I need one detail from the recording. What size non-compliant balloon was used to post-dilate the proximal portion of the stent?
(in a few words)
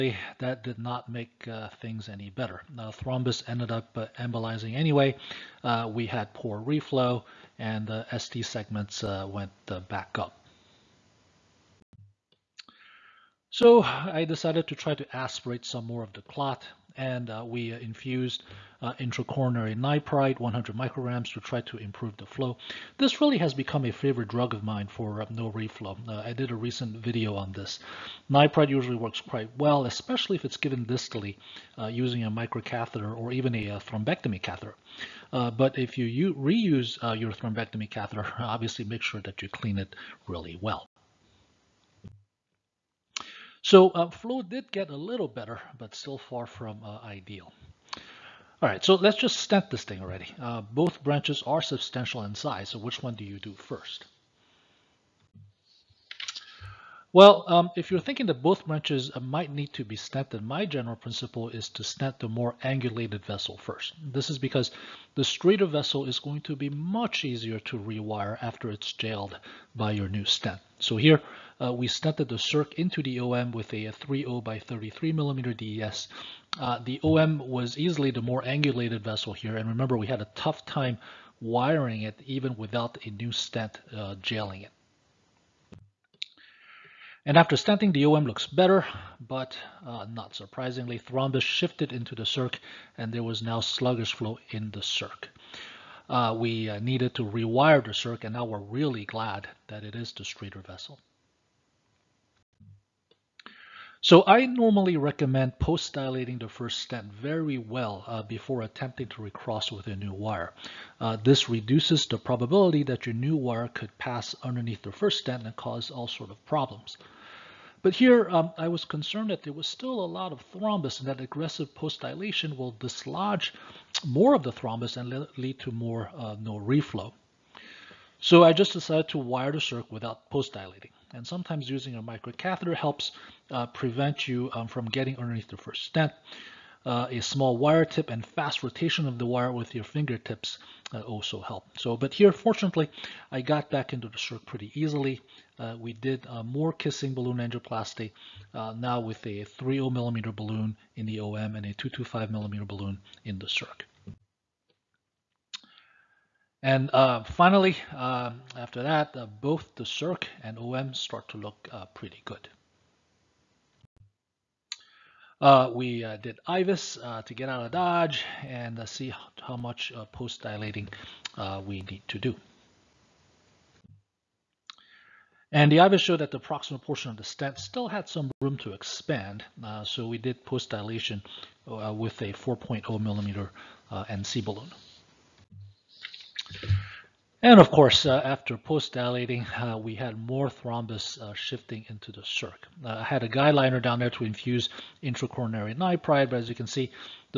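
4.0 millimeter.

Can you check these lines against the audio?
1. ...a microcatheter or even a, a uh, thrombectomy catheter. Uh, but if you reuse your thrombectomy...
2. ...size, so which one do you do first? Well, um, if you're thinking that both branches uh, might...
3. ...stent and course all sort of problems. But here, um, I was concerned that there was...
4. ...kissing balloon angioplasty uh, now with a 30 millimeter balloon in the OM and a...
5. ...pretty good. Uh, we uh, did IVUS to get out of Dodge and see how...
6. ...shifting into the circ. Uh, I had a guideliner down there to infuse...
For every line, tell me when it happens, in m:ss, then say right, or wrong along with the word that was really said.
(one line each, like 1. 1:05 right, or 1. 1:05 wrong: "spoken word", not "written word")
1. 0:32 right
2. 0:52 right
3. 1:55 wrong: "cause", not "course"
4. 2:26 right
5. 2:41 right
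6. 3:11 right.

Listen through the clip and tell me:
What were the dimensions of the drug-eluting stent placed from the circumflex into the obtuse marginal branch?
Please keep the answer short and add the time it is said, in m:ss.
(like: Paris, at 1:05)
3.0 by 33 millimeter, at 1:13.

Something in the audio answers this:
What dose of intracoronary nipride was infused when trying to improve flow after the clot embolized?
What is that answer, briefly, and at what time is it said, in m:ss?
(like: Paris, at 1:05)
100 micrograms, at 0:20.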